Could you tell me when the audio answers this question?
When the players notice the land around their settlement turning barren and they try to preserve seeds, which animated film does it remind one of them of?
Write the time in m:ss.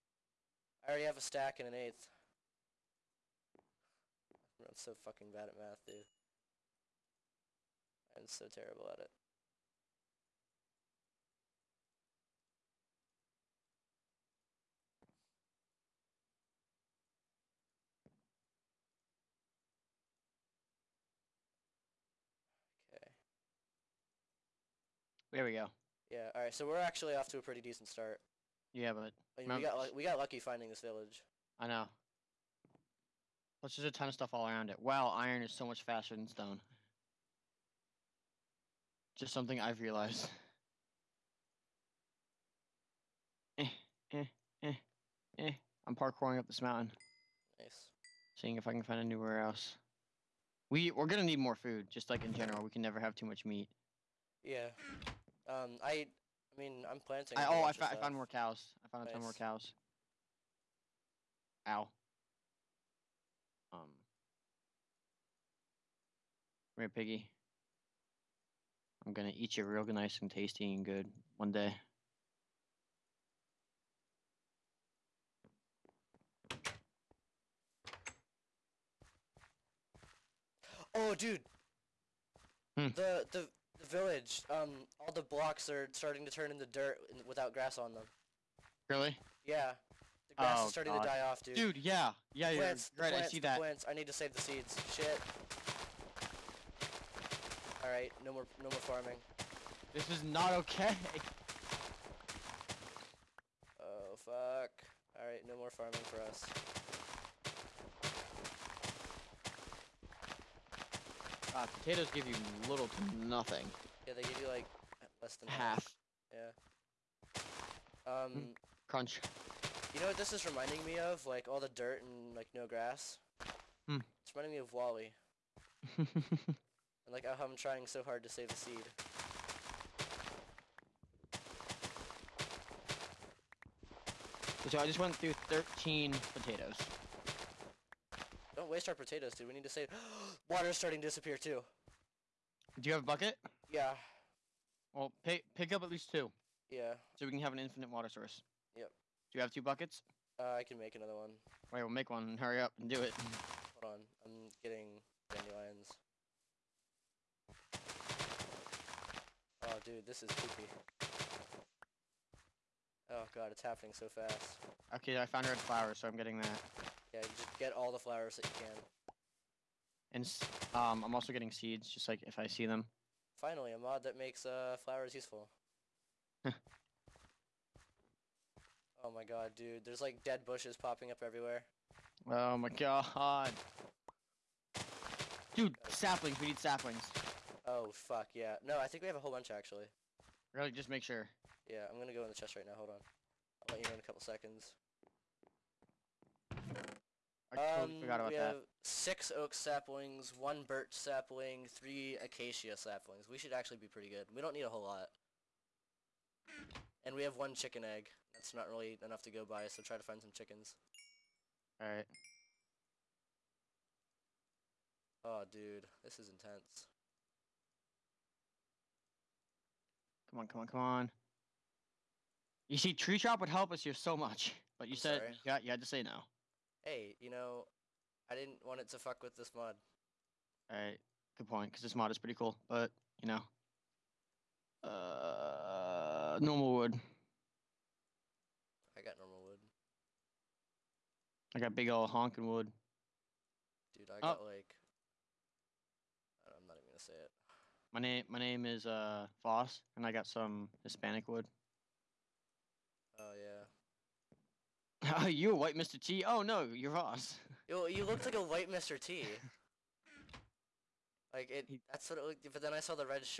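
2:04.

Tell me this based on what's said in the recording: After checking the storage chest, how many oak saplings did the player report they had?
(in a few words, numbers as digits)
6.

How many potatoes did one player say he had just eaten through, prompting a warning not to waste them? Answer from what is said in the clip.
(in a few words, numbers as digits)
13.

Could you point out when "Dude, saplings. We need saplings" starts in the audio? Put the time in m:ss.
3:05.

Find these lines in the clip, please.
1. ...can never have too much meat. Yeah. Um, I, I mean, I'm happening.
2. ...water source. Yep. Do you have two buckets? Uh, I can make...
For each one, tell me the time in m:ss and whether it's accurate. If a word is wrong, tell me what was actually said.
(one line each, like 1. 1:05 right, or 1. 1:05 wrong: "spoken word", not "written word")
1. 0:52 wrong: "planting", not "happening"
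2. 2:27 right.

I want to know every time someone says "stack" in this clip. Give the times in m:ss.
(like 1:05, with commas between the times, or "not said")
0:01.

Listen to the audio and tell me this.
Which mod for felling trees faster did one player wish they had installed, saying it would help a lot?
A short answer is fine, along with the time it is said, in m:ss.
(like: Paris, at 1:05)
Tree Chop, at 3:42.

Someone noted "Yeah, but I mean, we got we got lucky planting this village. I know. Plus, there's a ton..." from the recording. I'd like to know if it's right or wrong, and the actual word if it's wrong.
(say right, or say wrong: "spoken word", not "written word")
wrong: "finding", not "planting".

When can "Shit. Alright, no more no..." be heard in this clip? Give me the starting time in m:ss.
1:34.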